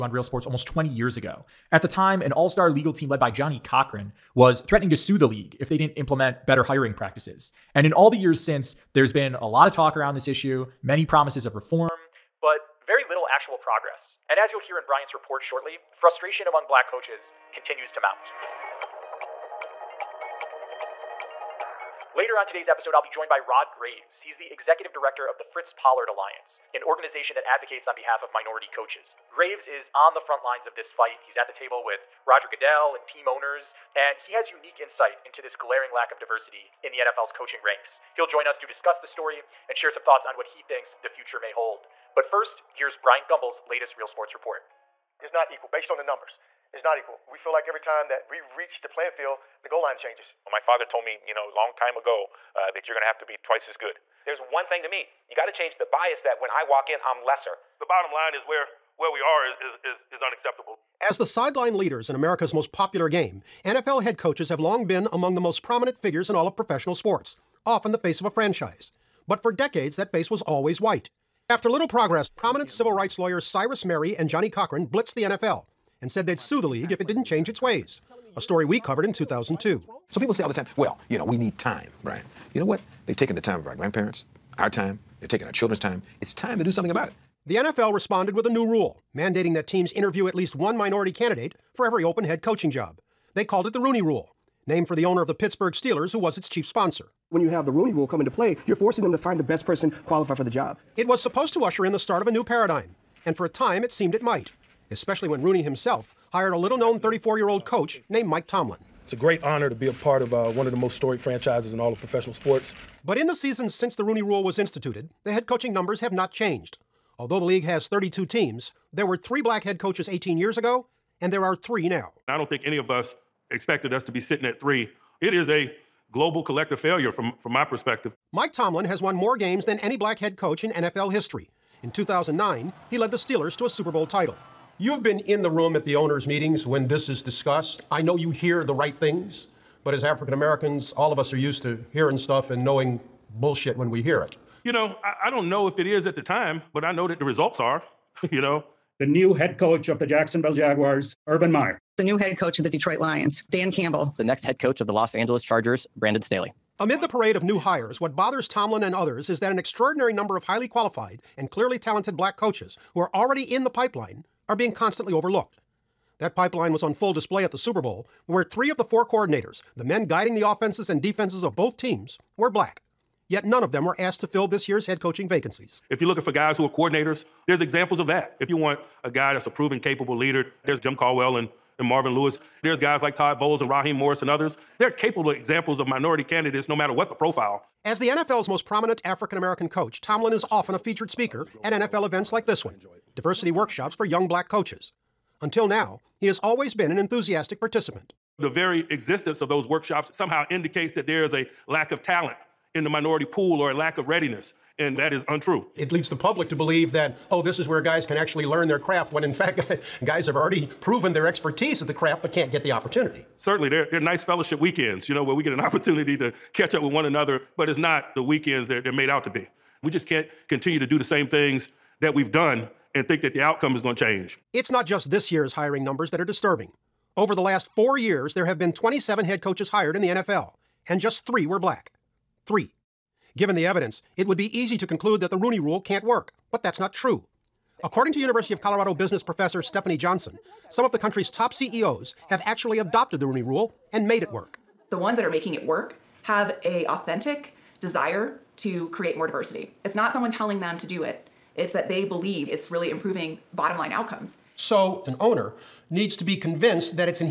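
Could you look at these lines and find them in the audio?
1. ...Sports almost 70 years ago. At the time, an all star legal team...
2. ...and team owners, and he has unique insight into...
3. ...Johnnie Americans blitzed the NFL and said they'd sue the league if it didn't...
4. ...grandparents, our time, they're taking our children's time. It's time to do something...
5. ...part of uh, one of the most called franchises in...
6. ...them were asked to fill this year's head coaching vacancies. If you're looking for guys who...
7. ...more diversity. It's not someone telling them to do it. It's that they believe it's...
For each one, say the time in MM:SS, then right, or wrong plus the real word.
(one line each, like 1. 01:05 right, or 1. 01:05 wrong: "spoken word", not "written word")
1. 00:00 wrong: "20", not "70"
2. 00:32 right
3. 01:14 wrong: "Cochran", not "Americans"
4. 01:23 right
5. 01:49 wrong: "storied", not "called"
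6. 02:53 right
7. 04:09 right.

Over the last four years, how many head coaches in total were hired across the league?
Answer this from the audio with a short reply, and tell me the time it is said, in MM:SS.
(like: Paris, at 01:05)
27, at 03:48.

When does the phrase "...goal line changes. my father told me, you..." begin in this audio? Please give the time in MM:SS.
00:49.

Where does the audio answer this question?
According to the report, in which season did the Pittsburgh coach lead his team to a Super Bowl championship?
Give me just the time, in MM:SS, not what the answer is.
02:11.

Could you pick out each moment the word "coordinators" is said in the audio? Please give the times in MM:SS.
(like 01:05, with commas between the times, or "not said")
02:49, 02:56.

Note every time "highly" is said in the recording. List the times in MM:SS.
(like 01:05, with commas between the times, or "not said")
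02:40.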